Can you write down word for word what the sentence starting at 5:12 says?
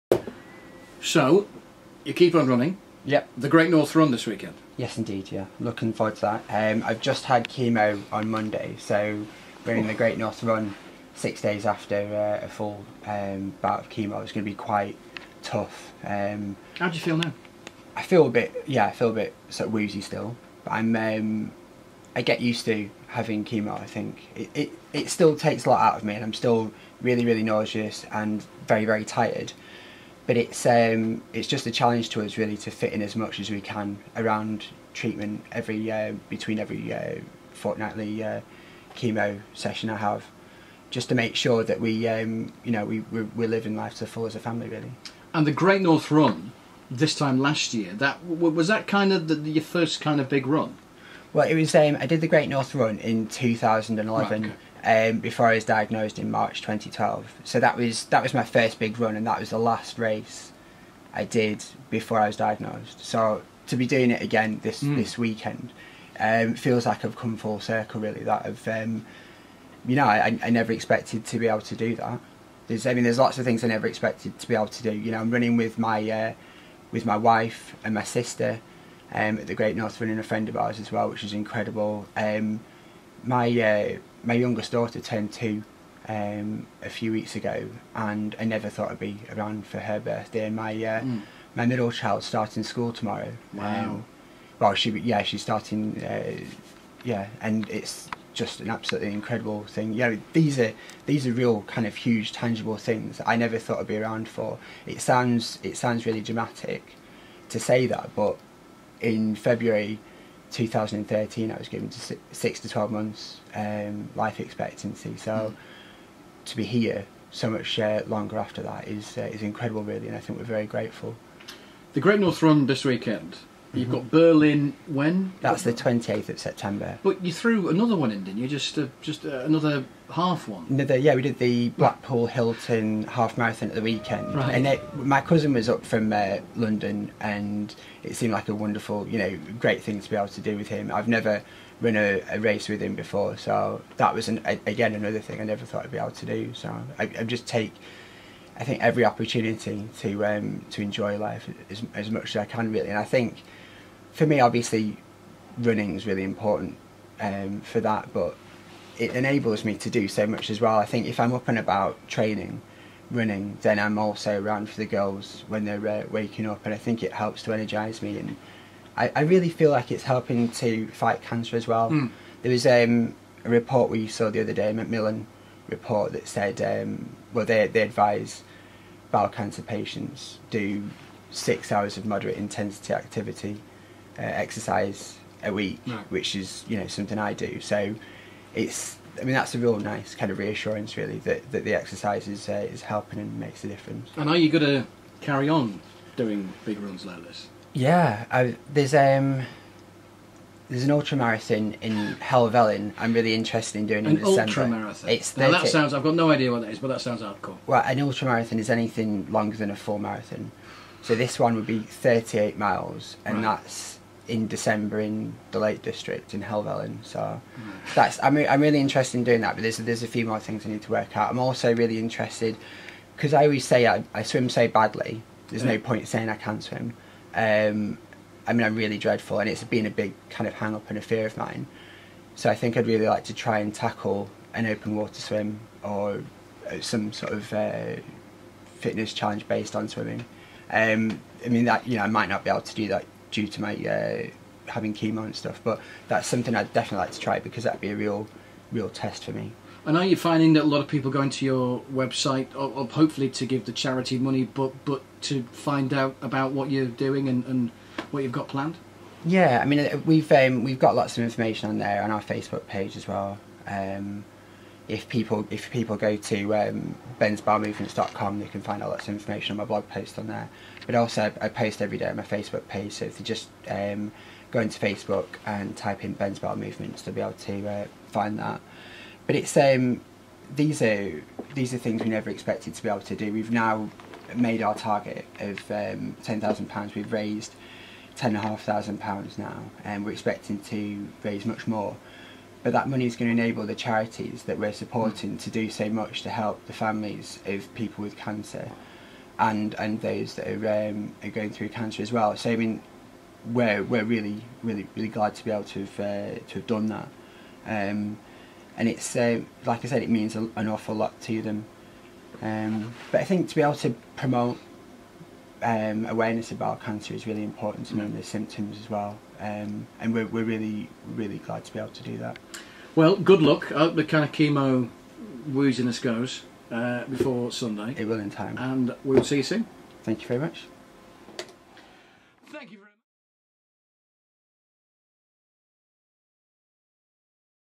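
Um, but I think to be able to promote um, awareness about cancer is really important to knowing the symptoms as well.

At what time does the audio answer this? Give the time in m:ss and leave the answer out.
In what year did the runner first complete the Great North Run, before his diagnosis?
0:53.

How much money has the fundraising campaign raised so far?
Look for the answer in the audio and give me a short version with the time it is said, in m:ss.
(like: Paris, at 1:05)
£10,500, at 4:48.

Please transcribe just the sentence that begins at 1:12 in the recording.
There's I mean there's lots of things I never expected to be able to do.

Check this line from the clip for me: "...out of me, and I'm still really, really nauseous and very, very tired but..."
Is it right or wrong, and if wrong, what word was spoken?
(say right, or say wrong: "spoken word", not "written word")
right.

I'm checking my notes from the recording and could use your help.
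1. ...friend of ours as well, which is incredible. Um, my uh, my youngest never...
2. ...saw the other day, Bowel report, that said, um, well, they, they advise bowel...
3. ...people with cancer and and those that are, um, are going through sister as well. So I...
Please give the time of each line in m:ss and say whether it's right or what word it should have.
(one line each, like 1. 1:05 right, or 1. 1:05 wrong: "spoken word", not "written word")
1. 1:20 wrong: "daughter", not "never"
2. 2:54 wrong: "Macmillan", not "Bowel"
3. 4:57 wrong: "cancer", not "sister".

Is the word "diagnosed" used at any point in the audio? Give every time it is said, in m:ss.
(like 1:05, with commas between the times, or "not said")
0:55, 1:02.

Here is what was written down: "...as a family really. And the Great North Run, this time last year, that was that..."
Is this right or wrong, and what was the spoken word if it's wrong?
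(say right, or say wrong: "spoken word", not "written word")
right.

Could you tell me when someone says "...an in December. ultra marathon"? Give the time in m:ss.
3:24.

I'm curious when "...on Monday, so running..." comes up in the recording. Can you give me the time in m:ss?
0:08.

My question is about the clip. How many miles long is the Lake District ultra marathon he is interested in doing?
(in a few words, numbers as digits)
38.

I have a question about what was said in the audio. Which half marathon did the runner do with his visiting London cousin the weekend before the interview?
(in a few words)
Blackpool Hilton half marathon.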